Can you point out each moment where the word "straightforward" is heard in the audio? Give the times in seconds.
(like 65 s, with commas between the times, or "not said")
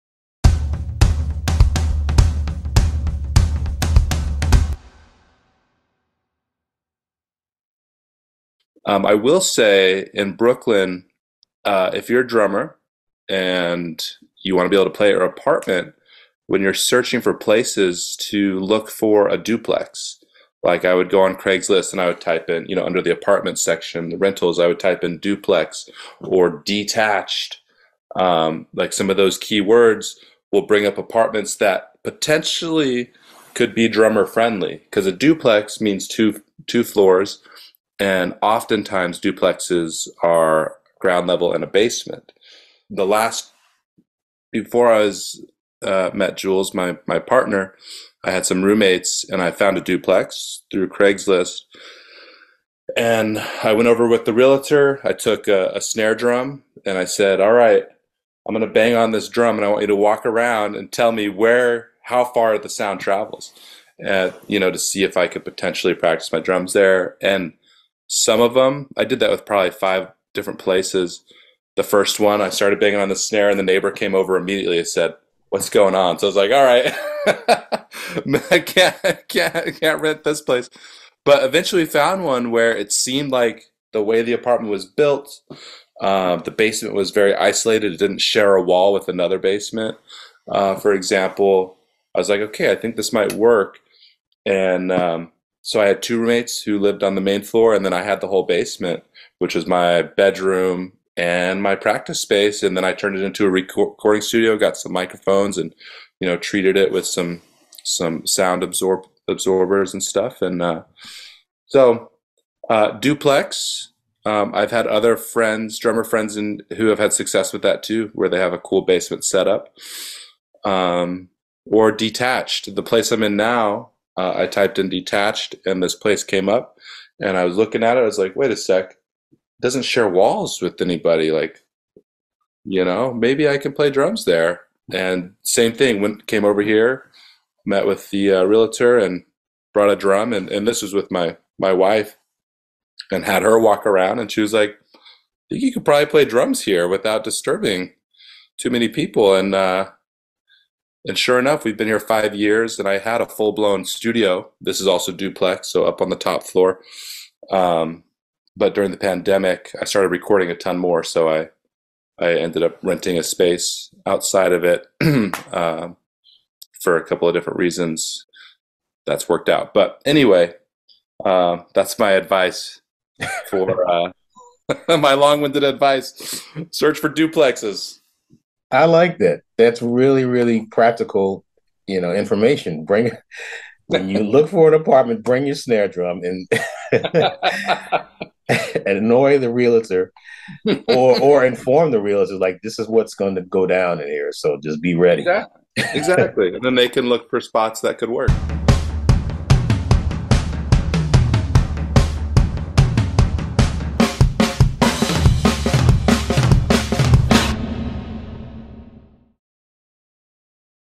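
not said.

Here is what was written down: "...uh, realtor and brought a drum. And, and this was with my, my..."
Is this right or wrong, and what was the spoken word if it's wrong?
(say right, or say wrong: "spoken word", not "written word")
right.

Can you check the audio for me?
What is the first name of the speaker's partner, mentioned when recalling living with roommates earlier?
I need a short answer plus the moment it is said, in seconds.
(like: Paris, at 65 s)
Jules, at 46 s.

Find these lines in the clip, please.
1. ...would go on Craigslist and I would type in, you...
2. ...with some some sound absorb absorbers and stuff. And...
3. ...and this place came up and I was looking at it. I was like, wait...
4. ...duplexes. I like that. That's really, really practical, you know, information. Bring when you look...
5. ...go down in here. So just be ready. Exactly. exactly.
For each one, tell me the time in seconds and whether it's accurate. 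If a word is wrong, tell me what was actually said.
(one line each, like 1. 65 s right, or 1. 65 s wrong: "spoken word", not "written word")
1. 20 s right
2. 106 s right
3. 125 s right
4. 177 s right
5. 193 s right.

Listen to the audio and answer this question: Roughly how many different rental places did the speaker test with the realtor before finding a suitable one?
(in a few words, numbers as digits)
5.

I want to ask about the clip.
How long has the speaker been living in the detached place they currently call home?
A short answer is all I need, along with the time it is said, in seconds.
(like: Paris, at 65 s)
5 years, at 151 s.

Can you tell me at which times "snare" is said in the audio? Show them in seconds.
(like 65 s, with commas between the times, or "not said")
55 s, 73 s, 185 s.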